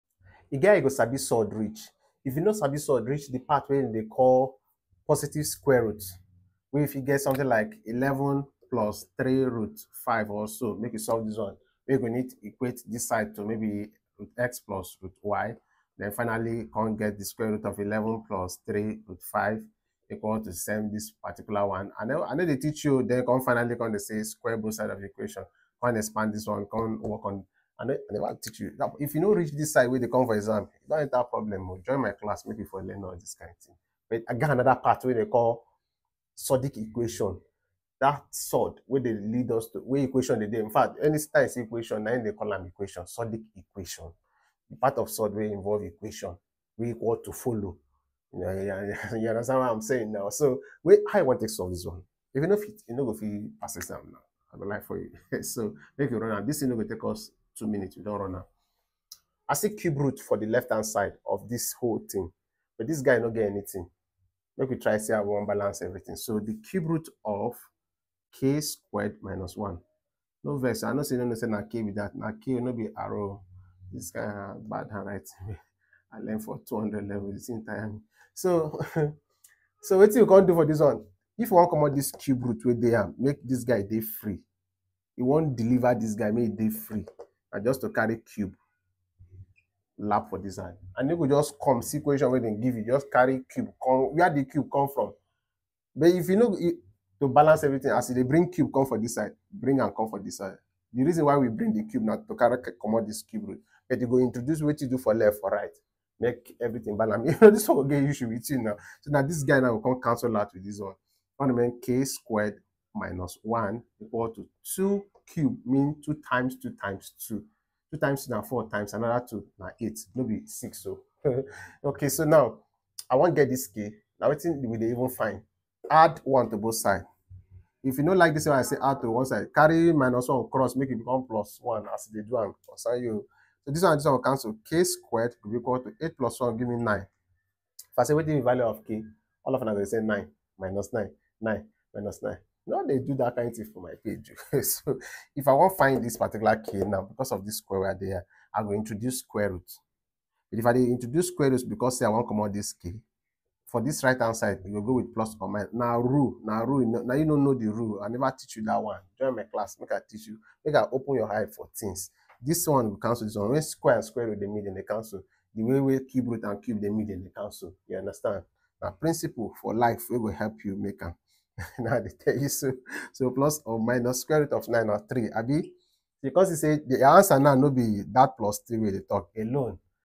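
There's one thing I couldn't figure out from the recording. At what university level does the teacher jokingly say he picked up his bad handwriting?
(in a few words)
200 level.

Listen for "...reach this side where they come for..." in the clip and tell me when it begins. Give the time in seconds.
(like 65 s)
29 s.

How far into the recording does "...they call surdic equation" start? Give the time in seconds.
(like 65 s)
35 s.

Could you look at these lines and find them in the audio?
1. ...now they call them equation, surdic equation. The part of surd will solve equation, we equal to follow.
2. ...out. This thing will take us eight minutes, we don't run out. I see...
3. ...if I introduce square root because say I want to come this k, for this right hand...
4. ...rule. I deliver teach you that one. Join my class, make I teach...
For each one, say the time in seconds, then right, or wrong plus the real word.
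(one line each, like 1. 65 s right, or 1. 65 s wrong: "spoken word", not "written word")
1. 42 s wrong: "involve", not "solve"
2. 56 s wrong: "two", not "eight"
3. 150 s right
4. 157 s wrong: "never", not "deliver".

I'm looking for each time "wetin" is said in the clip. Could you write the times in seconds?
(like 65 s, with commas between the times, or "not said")
124 s, 138 s.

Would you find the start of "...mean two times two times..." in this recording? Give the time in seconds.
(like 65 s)
115 s.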